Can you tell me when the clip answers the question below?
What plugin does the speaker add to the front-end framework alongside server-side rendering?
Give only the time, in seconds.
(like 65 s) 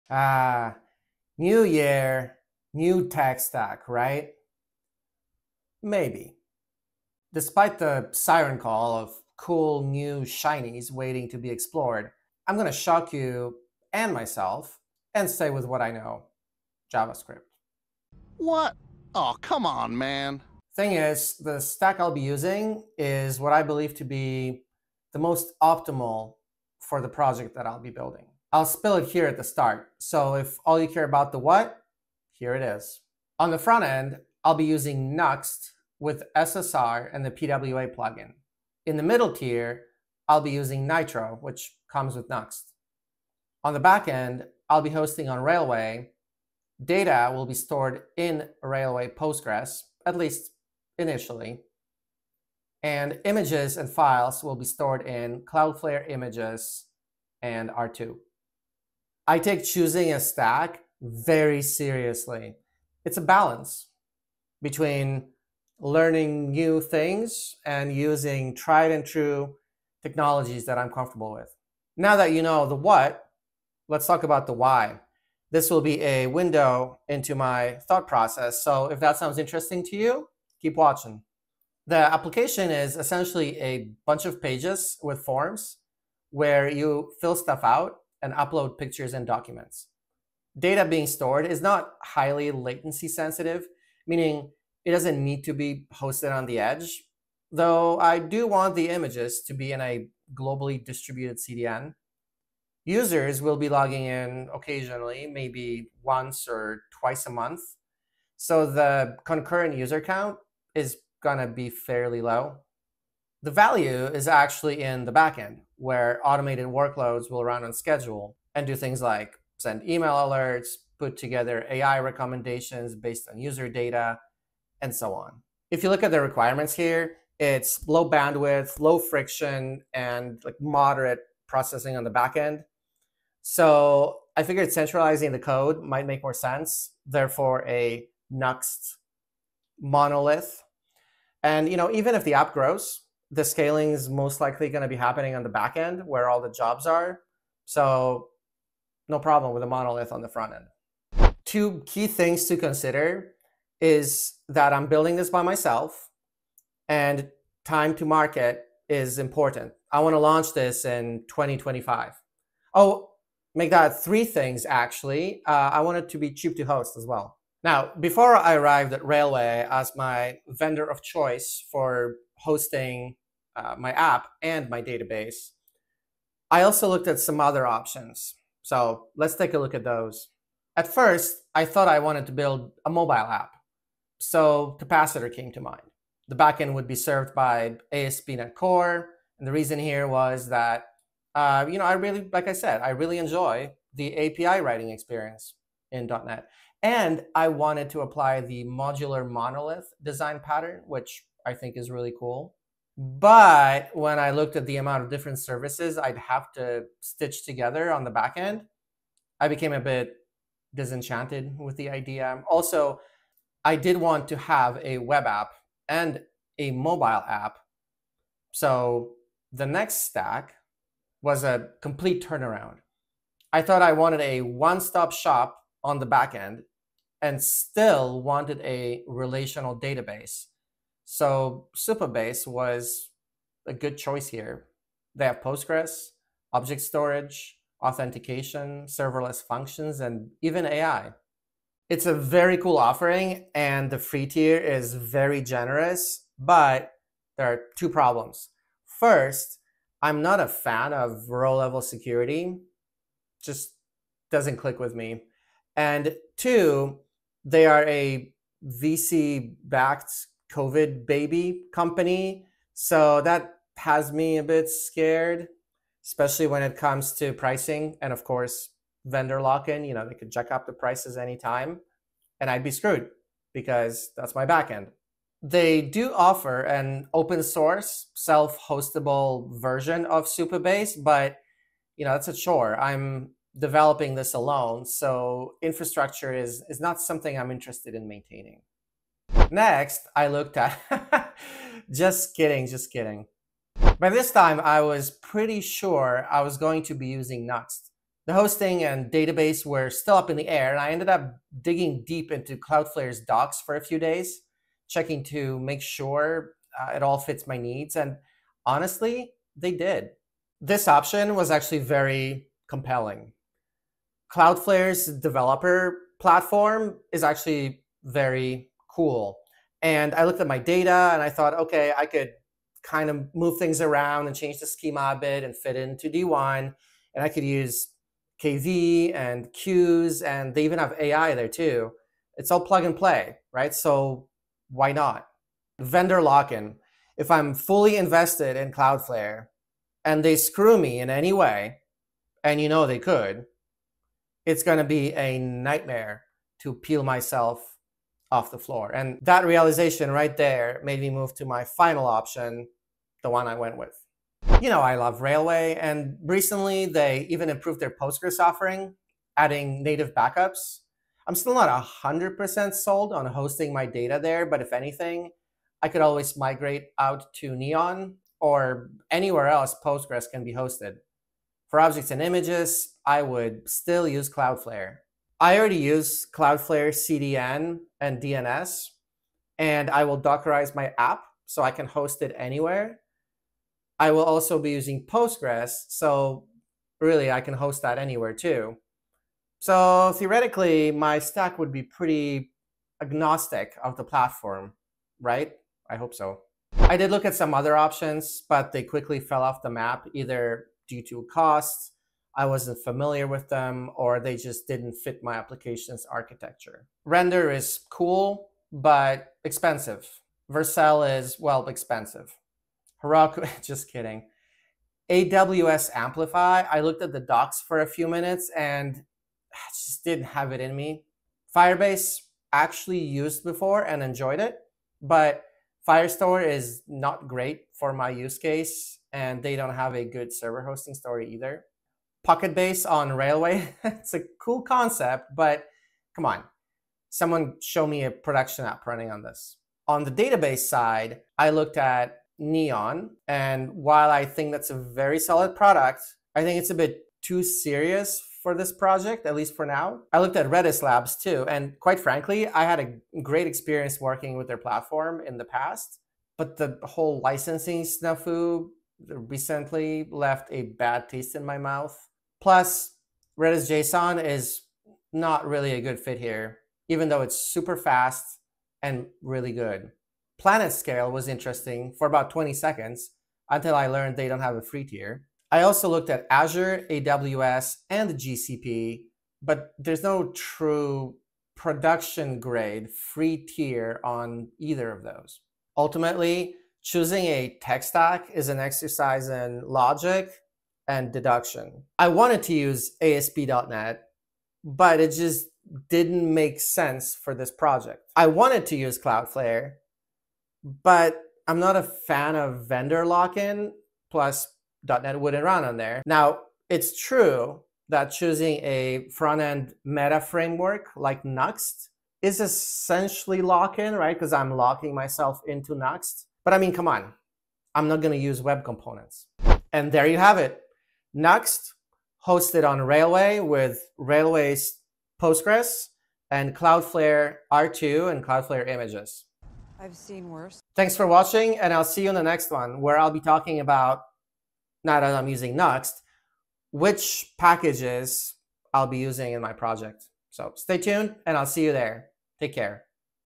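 37 s.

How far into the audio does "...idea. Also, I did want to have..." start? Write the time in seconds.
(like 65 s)
211 s.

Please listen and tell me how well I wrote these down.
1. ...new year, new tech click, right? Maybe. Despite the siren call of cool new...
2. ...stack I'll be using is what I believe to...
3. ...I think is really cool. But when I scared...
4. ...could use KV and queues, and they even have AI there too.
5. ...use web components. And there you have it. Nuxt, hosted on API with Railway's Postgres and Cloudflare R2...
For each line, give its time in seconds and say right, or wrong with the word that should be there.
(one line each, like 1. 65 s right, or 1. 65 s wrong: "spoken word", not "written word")
1. 1 s wrong: "stack", not "click"
2. 21 s right
3. 201 s wrong: "looked", not "scared"
4. 327 s right
5. 518 s wrong: "Railway", not "API".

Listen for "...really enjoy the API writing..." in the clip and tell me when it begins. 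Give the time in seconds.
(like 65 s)
192 s.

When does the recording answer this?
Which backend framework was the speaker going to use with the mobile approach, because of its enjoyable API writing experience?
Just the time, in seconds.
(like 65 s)
187 s.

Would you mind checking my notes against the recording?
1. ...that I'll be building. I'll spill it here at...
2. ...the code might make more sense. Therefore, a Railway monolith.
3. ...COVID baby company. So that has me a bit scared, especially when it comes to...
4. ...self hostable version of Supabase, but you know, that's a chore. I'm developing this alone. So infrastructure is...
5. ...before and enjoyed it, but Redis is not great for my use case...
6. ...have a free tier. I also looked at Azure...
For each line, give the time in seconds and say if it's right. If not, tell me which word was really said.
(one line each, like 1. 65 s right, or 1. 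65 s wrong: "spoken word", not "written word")
1. 27 s right
2. 135 s wrong: "Nuxt", not "Railway"
3. 260 s right
4. 278 s right
5. 423 s wrong: "Firestore", not "Redis"
6. 474 s right.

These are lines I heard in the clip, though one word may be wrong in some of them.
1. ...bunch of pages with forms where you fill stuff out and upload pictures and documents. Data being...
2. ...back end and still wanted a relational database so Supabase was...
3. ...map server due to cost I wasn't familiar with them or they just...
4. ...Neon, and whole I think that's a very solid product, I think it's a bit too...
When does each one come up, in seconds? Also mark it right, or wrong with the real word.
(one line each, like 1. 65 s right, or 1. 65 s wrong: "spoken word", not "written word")
1. 84 s right
2. 226 s right
3. 399 s wrong: "either", not "server"
4. 442 s wrong: "while", not "whole".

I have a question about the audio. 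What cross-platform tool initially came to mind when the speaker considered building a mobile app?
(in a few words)
Capacitor.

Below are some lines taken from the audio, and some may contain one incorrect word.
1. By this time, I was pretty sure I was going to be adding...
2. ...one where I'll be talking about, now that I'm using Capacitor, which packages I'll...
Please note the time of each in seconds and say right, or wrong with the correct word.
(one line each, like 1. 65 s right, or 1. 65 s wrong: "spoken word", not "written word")
1. 293 s wrong: "using", not "adding"
2. 532 s wrong: "Nuxt", not "Capacitor".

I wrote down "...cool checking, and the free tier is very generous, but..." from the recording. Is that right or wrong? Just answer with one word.
wrong.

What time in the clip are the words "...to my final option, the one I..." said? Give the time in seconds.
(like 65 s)
351 s.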